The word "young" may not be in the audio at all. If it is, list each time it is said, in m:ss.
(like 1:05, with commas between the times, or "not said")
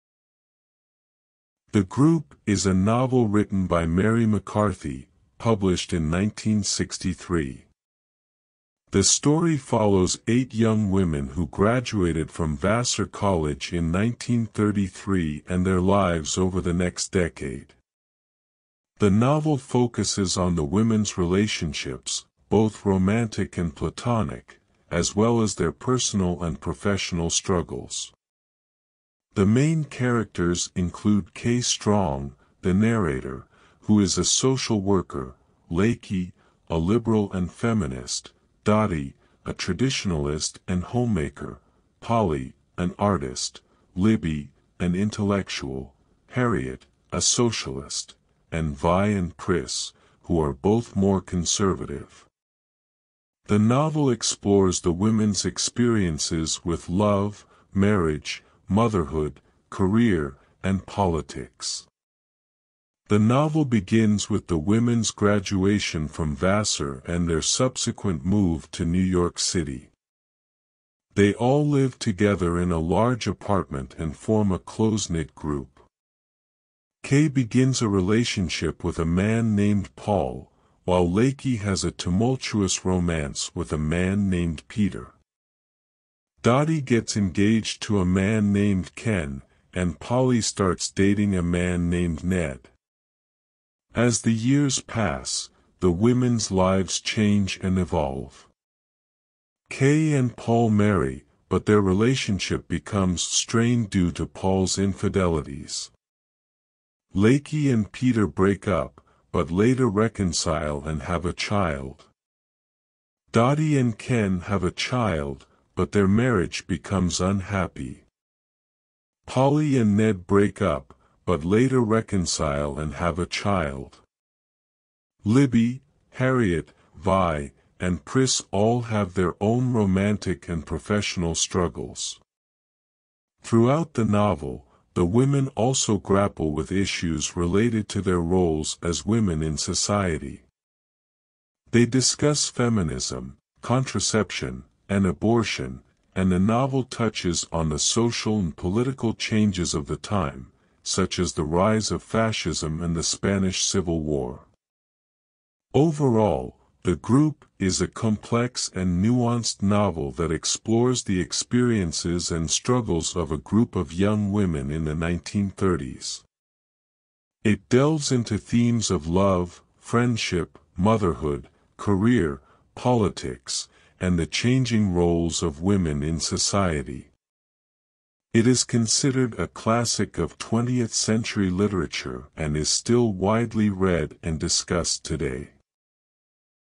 0:10, 2:43.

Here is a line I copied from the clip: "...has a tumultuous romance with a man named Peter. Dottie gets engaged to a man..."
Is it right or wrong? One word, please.
right.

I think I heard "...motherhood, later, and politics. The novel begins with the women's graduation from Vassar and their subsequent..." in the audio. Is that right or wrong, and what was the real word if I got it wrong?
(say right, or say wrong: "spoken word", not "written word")
wrong: "career", not "later".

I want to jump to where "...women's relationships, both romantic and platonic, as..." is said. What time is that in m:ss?
0:20.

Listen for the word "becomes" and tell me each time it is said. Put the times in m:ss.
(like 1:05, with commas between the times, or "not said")
1:42, 1:56.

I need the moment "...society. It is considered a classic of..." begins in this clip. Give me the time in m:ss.
2:56.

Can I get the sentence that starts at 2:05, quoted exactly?
Libby, Harriot, Vi, and Priss all have their own romantic and professional struggles.